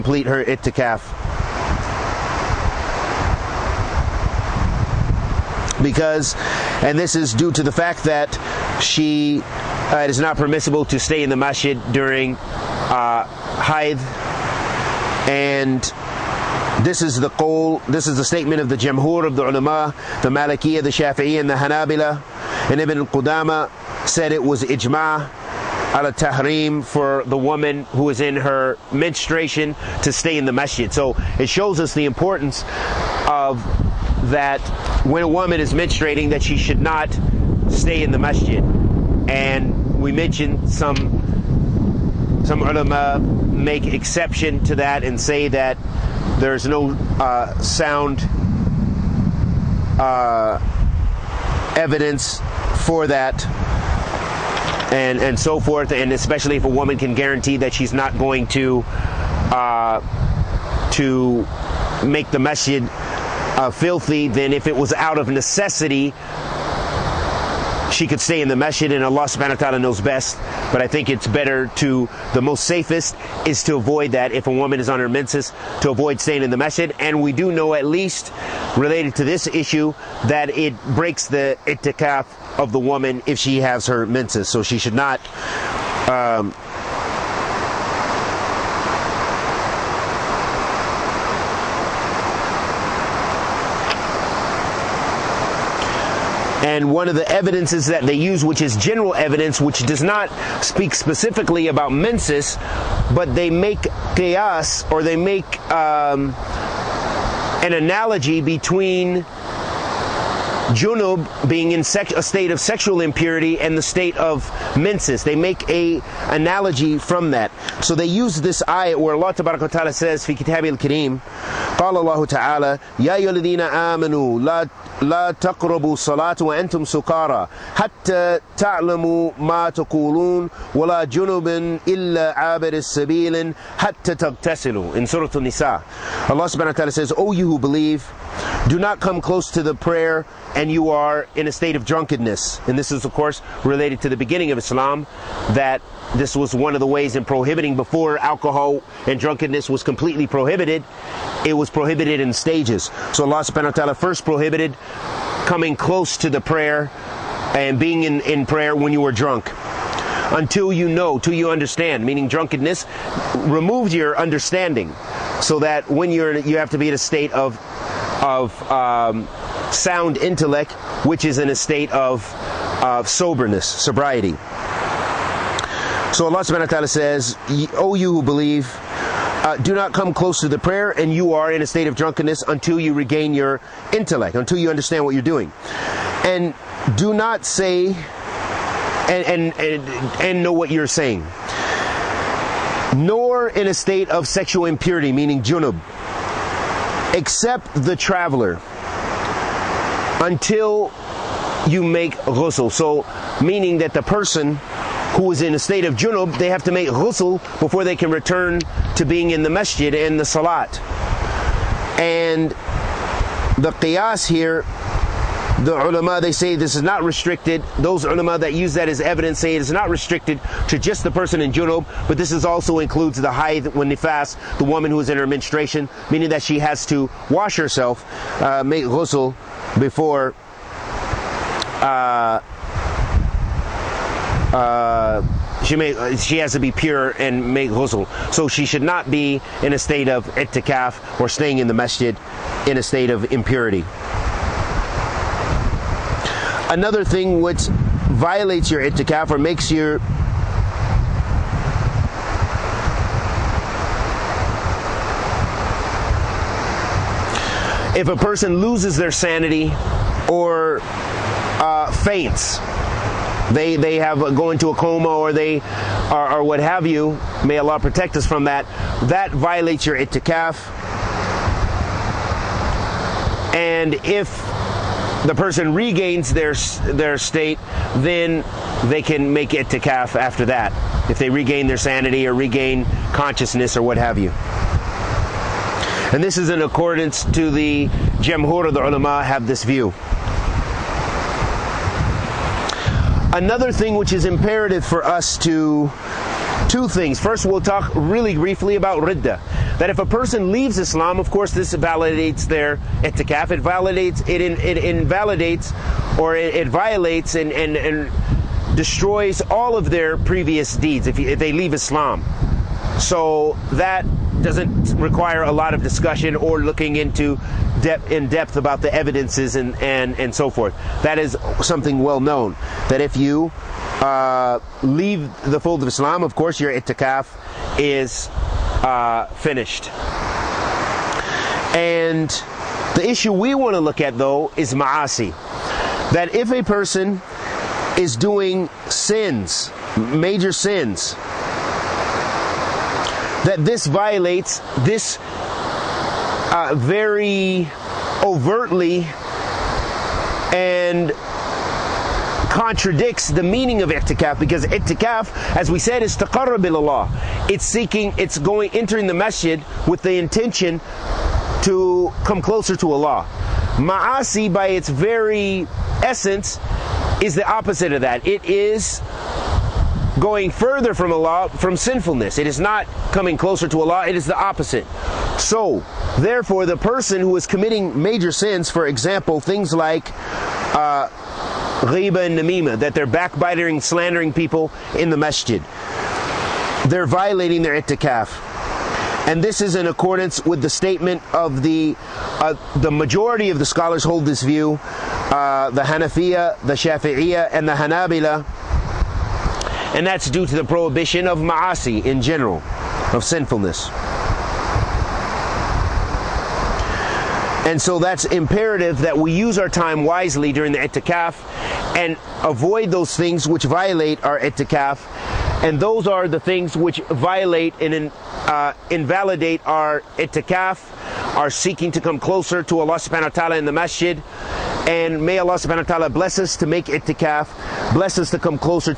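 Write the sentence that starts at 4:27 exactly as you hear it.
May Allah protect us from that.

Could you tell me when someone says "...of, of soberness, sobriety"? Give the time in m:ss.
2:51.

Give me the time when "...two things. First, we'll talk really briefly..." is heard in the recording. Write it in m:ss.
4:56.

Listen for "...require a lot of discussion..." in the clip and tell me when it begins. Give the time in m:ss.
5:14.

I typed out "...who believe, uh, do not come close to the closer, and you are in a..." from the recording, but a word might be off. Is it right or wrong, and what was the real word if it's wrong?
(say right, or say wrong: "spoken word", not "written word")
wrong: "prayer", not "closer".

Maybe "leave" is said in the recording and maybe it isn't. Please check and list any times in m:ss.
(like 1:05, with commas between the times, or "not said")
5:00, 5:11, 5:24.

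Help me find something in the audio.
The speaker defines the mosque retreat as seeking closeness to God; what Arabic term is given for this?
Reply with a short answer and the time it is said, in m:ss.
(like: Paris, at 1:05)
taqarrub, at 5:56.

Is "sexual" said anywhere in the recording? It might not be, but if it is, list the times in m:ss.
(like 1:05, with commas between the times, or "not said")
1:52, 3:14.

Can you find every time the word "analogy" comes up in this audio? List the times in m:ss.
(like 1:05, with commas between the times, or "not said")
1:47, 1:56.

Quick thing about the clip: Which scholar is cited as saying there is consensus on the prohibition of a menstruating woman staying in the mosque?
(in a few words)
Ibn Qudama.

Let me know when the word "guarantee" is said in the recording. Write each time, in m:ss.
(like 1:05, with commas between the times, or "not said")
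0:57.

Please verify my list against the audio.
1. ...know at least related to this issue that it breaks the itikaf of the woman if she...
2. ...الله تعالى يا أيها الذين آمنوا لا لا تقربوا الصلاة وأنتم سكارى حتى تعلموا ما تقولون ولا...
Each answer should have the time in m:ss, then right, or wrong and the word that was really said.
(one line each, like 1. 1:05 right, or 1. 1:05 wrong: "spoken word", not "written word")
1. 1:17 right
2. 2:01 right.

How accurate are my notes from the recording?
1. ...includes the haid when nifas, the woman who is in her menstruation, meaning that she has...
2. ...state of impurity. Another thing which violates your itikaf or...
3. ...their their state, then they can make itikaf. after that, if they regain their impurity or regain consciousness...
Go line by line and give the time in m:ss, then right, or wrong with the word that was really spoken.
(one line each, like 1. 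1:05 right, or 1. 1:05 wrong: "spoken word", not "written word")
1. 3:42 right
2. 4:02 right
3. 4:36 wrong: "sanity", not "impurity".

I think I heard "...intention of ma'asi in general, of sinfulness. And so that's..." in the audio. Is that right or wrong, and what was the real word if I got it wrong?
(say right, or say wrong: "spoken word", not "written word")
wrong: "prohibition", not "intention".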